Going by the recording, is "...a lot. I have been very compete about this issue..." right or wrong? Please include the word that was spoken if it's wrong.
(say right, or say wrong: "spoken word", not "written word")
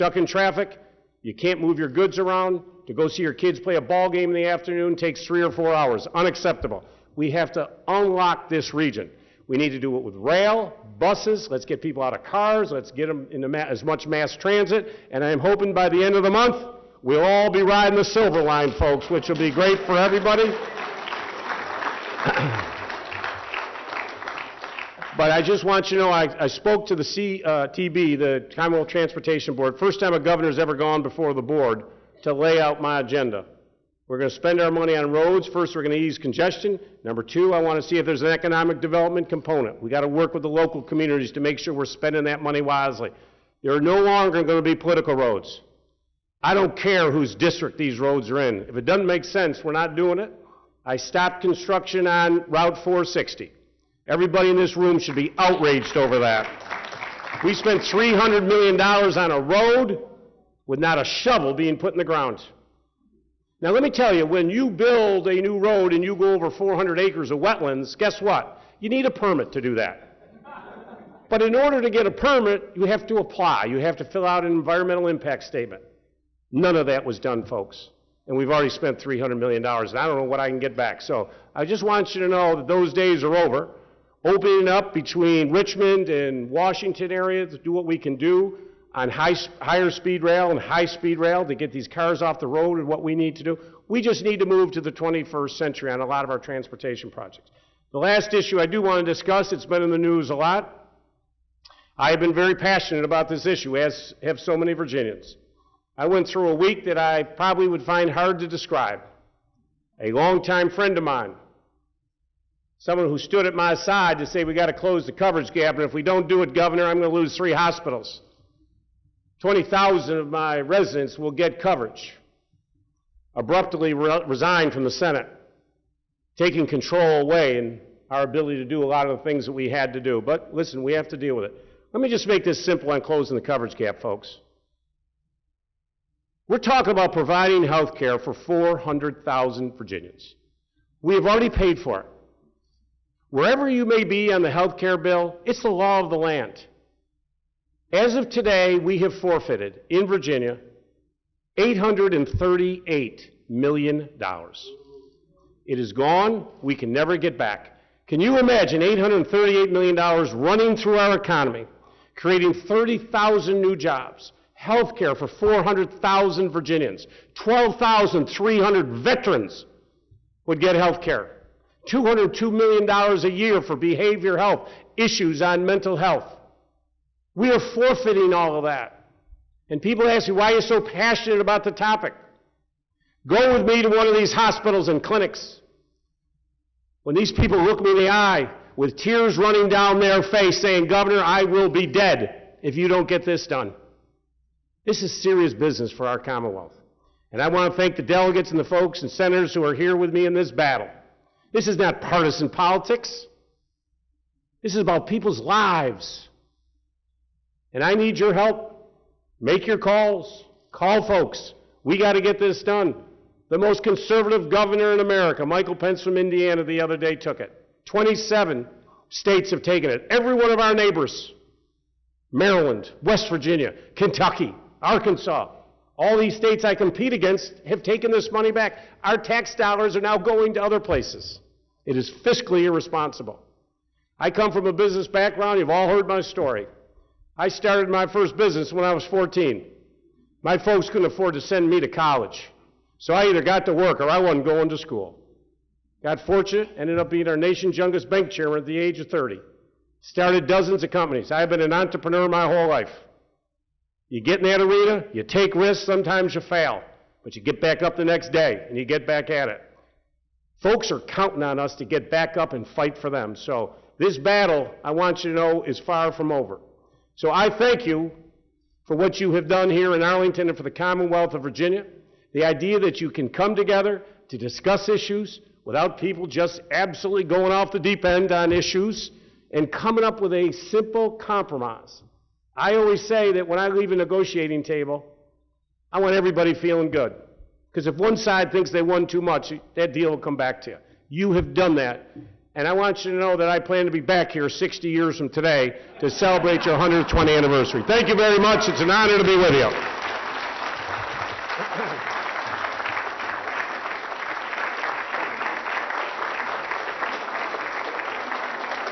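wrong: "passionate", not "compete".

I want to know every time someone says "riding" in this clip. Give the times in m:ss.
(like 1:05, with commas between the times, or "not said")
0:17.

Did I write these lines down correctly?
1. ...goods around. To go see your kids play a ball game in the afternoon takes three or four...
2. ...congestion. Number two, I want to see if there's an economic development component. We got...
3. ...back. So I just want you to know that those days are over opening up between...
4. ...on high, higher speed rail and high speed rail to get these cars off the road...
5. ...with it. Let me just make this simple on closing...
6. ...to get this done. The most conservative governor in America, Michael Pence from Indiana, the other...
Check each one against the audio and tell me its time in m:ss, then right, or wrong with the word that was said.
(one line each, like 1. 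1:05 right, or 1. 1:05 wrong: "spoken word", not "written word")
1. 0:01 right
2. 0:36 right
3. 1:20 right
4. 1:28 right
5. 2:11 right
6. 3:32 right.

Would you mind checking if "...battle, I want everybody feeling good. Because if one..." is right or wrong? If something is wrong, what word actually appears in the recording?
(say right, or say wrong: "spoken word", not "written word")
wrong: "table", not "battle".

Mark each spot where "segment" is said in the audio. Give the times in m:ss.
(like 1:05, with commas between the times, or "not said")
not said.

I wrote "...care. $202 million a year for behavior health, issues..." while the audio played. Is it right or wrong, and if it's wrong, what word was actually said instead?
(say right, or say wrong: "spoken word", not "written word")
right.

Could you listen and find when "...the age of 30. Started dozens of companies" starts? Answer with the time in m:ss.
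4:08.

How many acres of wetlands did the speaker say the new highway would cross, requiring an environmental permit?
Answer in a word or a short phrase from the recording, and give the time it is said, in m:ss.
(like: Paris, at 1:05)
400, at 1:06.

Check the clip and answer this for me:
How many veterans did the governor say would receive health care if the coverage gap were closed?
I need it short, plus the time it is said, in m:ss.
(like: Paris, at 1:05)
12,300, at 2:47.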